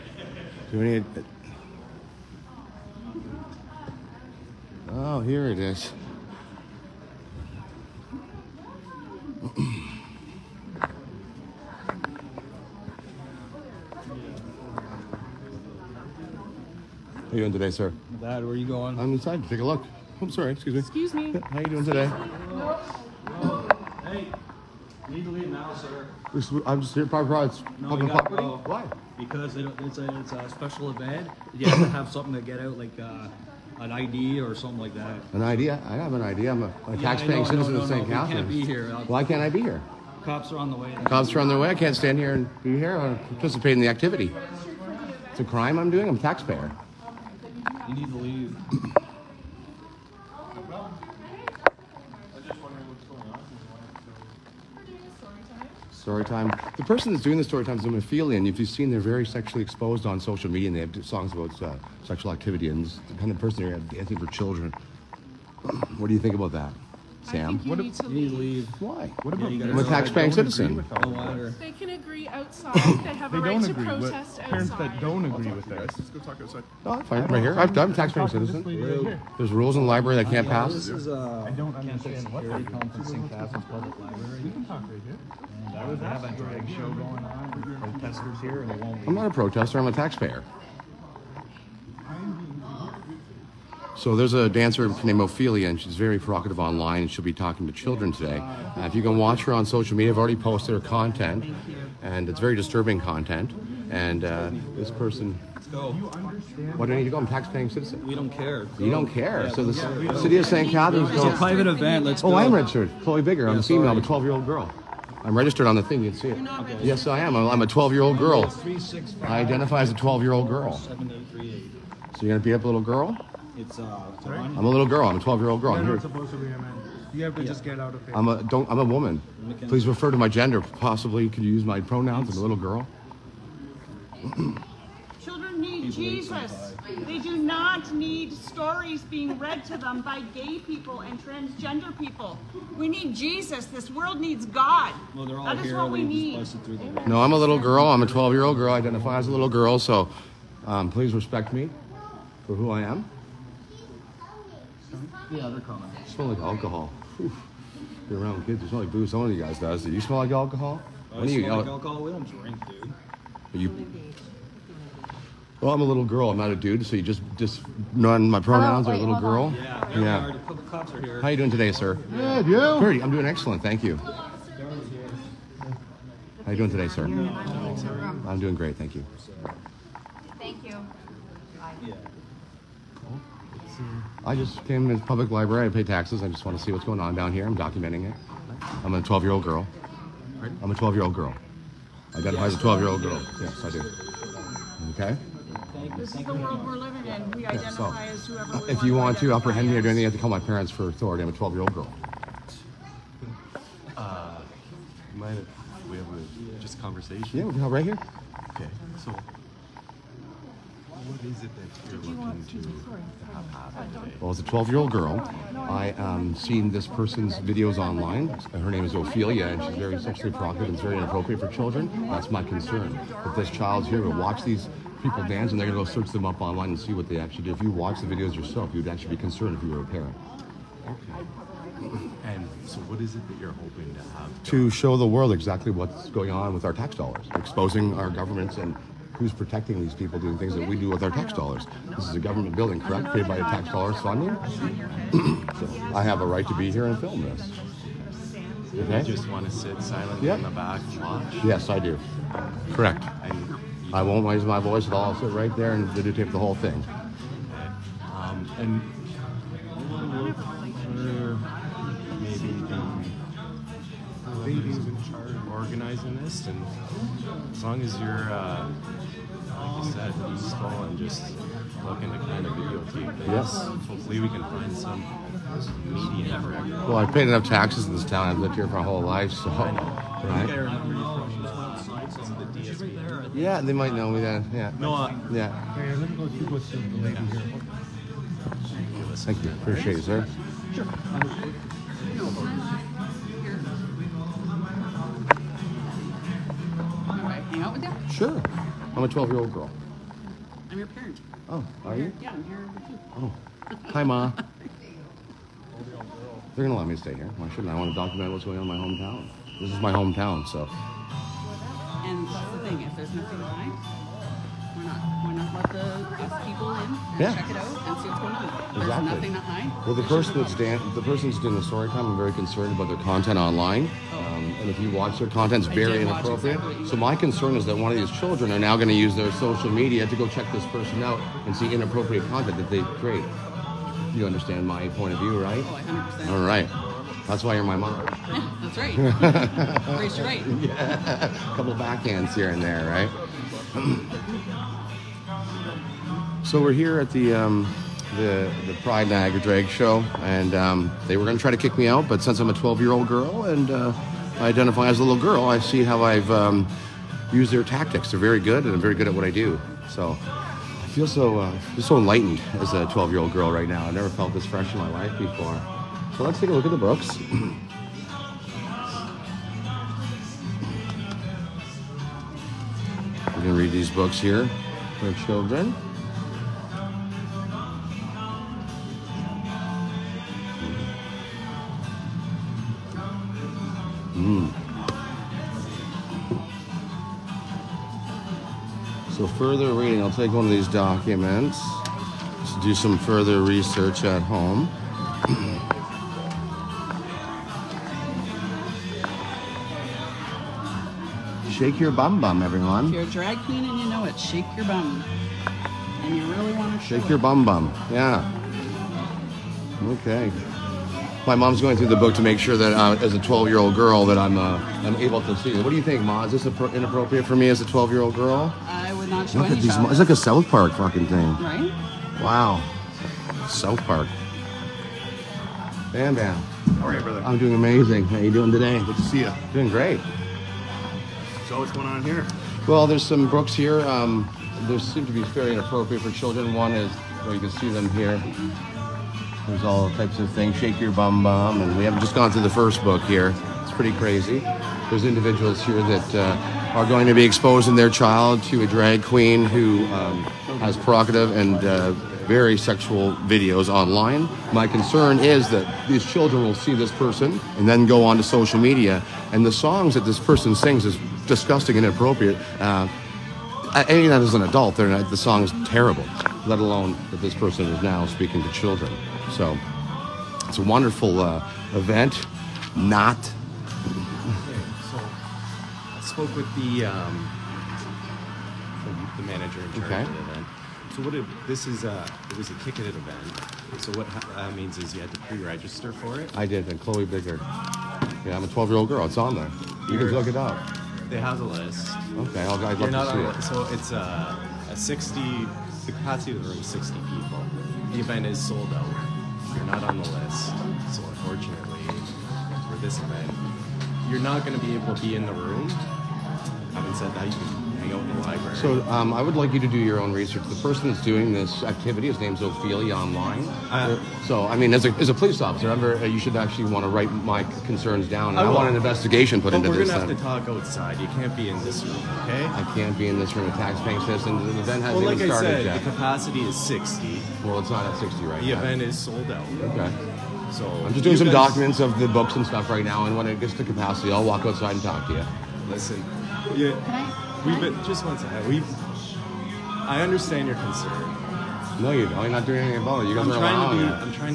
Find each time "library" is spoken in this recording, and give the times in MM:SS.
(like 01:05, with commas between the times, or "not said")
01:19, 03:05, 08:28.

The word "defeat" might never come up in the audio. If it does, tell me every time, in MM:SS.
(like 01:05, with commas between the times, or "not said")
not said.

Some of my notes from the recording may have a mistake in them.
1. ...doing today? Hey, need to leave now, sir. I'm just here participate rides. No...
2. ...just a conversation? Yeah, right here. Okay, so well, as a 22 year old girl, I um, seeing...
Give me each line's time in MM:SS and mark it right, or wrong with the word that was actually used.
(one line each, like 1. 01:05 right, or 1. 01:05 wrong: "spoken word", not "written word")
1. 00:21 wrong: "private", not "participate"
2. 03:26 wrong: "12", not "22".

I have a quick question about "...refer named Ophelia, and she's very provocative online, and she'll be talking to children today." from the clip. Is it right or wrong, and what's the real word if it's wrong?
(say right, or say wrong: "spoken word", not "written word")
wrong: "dancer", not "refer".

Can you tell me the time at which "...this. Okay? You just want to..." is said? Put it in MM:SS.
04:07.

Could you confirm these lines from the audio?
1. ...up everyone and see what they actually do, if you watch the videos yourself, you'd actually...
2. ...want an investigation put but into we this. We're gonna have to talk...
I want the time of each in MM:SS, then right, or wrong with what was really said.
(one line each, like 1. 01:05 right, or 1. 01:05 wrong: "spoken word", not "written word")
1. 03:46 wrong: "online", not "everyone"
2. 08:38 right.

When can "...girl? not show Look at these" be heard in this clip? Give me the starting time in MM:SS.
06:58.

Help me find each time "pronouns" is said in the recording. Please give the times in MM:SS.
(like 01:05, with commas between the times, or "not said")
02:11, 02:48.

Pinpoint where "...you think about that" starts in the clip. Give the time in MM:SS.
01:06.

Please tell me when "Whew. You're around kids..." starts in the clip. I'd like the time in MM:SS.
02:37.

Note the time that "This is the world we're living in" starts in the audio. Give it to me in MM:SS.
03:15.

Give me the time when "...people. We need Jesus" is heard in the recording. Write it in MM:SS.
02:21.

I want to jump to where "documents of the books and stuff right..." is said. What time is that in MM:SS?
08:51.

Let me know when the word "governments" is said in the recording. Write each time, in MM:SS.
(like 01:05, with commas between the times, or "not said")
03:58, 04:02.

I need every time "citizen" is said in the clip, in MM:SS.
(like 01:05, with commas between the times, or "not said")
00:37, 01:10, 01:18, 01:47, 08:44.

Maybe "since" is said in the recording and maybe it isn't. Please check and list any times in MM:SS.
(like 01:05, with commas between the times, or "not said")
05:52.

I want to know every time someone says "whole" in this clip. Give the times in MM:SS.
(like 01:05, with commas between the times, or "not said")
04:16, 04:38.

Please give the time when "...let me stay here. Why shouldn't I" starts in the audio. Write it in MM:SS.
05:06.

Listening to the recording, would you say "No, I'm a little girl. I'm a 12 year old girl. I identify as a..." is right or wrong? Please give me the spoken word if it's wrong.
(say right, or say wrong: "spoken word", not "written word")
right.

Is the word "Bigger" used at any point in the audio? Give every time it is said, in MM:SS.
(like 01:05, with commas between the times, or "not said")
01:53, 08:07.